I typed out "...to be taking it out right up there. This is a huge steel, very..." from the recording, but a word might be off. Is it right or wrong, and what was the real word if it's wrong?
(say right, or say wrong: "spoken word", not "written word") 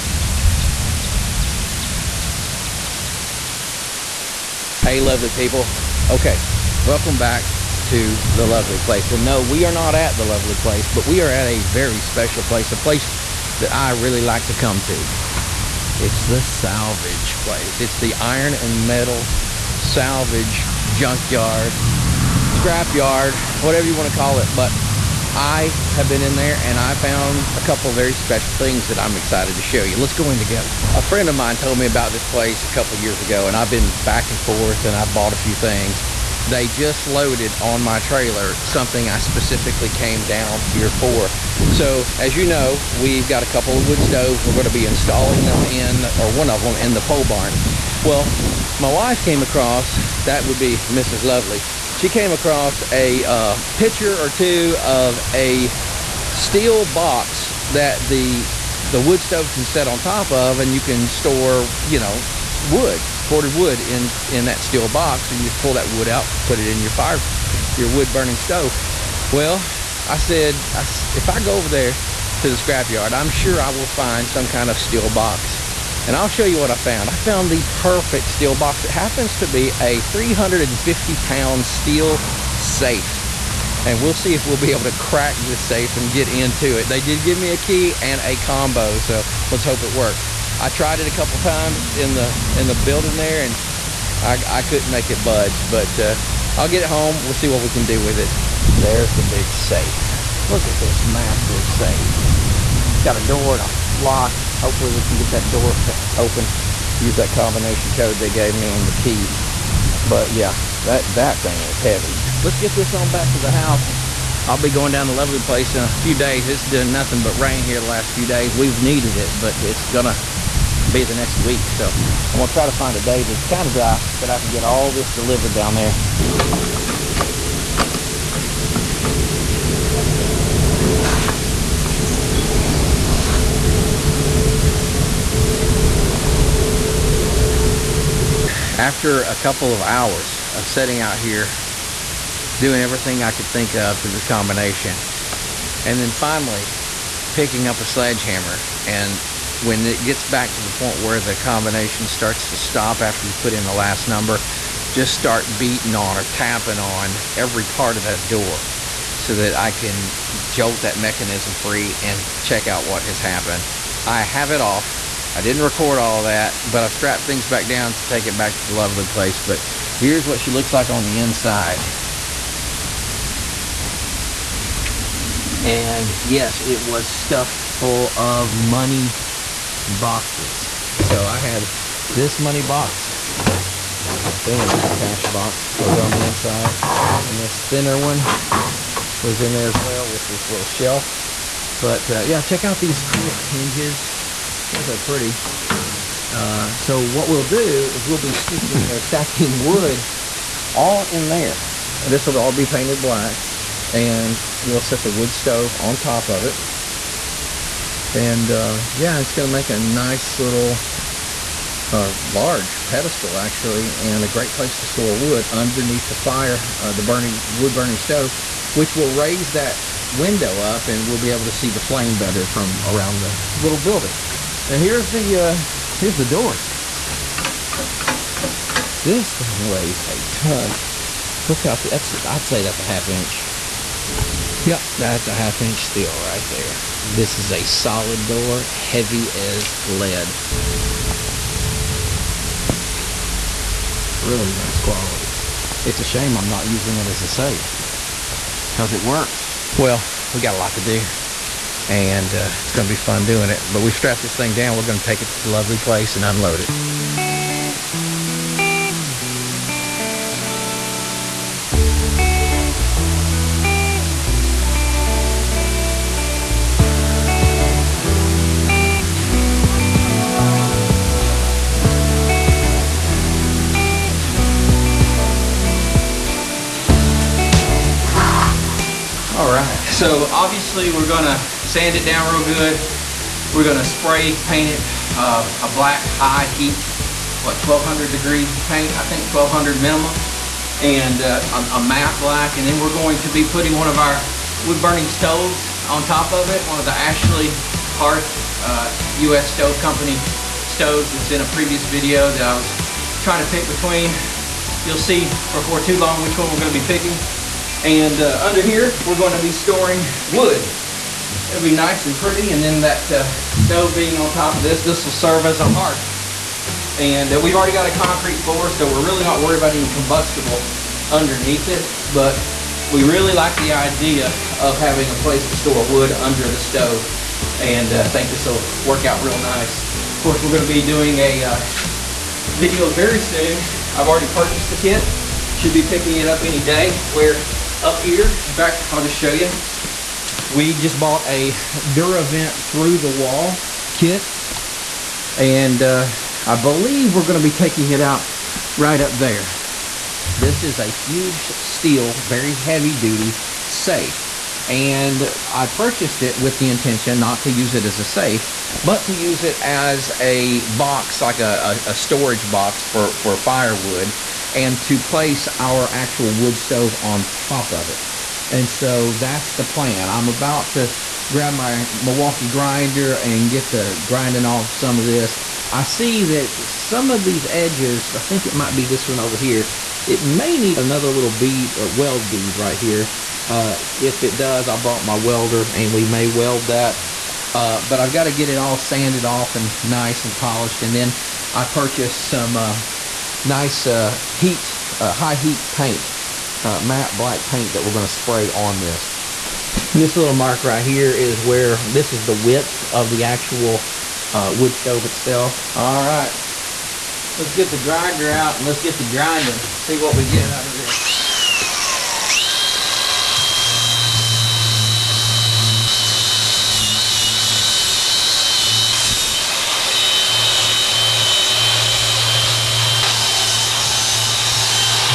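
right.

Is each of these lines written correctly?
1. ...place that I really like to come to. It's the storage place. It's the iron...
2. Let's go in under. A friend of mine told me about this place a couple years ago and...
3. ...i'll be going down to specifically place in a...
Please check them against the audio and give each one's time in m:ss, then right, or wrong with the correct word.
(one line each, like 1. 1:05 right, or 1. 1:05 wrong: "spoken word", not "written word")
1. 0:12 wrong: "salvage", not "storage"
2. 0:29 wrong: "together", not "under"
3. 1:54 wrong: "lovely", not "specifically".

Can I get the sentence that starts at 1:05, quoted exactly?
So you just pull that wood out, put it in your fire, your wood burning stove.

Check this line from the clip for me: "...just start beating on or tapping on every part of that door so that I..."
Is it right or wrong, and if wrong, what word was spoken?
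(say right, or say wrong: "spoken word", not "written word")
right.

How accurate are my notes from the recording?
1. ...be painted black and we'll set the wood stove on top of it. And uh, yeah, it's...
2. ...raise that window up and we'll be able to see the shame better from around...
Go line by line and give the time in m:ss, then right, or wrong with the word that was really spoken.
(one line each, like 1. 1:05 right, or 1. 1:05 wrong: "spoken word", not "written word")
1. 3:22 right
2. 3:39 wrong: "flame", not "shame".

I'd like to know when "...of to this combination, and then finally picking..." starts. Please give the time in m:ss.
2:23.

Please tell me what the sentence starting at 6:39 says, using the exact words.
This little mark right here is where this is the width of the actual uh, wood stove itself.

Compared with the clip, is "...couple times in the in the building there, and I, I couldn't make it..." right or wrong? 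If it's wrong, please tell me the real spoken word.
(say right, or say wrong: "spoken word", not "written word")
right.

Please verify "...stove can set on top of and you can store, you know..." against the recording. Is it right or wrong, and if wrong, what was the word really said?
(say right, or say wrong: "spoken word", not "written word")
right.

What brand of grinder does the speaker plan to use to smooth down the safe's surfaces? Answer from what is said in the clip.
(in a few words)
Milwaukee.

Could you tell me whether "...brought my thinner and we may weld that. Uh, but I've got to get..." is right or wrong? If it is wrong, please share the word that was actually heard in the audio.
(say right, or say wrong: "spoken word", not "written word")
wrong: "welder", not "thinner".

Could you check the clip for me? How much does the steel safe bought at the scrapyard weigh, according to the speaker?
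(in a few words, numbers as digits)
350 pounds.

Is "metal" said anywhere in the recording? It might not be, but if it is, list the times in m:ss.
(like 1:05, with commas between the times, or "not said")
0:18.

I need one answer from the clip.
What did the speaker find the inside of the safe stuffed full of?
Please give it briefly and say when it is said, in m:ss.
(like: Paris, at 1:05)
money boxes, at 2:58.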